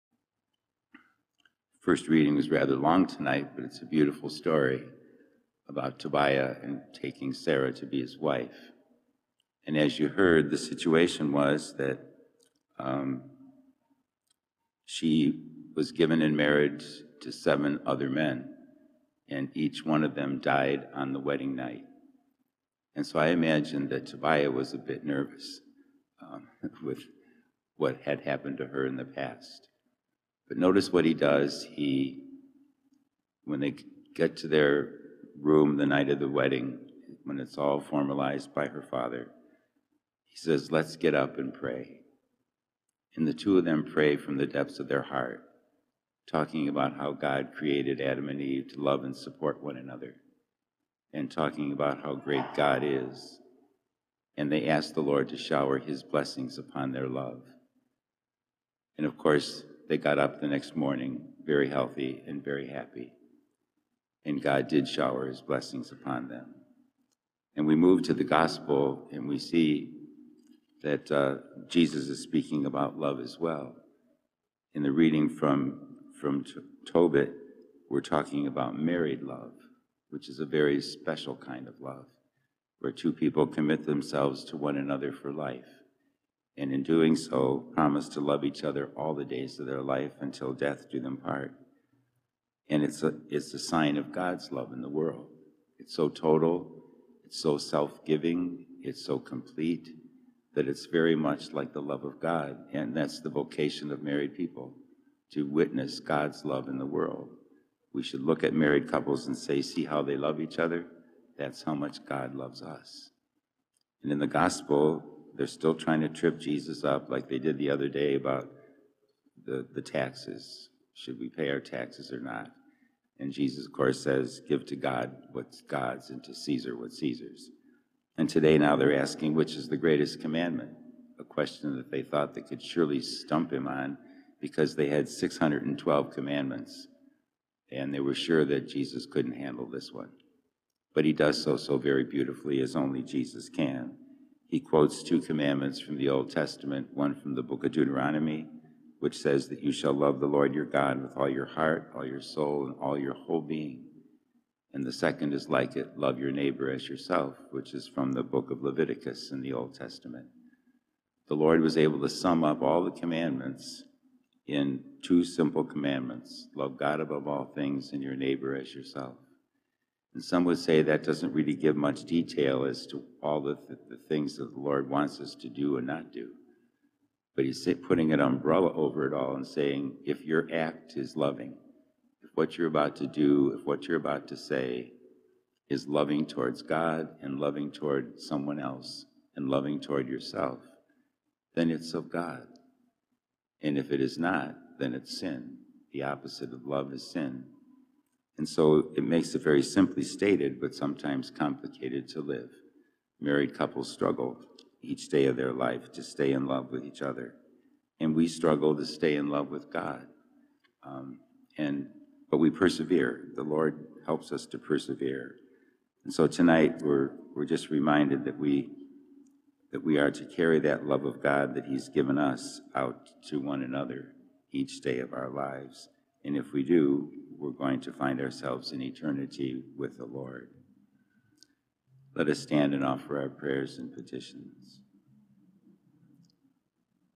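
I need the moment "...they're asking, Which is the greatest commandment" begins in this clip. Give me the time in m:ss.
2:08.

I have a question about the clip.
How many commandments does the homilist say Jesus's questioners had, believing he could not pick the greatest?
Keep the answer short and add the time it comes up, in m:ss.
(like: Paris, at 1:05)
612, at 2:15.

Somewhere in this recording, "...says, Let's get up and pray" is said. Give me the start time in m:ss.
0:40.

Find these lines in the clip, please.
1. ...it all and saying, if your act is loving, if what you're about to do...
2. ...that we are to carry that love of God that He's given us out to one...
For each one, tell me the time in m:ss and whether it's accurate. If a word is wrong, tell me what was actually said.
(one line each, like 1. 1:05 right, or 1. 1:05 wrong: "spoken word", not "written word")
1. 2:59 right
2. 3:39 right.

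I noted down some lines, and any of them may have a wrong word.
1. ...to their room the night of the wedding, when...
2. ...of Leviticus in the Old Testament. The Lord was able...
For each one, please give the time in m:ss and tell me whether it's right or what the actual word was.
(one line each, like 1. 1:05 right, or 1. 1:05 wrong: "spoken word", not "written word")
1. 0:34 right
2. 2:38 right.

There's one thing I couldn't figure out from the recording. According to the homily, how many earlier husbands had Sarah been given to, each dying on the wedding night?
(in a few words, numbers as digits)
7.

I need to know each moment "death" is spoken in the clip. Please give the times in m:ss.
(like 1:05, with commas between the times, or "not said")
1:30.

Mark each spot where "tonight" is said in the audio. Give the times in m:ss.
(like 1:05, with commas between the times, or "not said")
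0:03, 3:36.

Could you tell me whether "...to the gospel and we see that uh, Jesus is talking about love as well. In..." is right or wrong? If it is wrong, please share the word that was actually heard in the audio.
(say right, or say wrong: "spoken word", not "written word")
wrong: "speaking", not "talking".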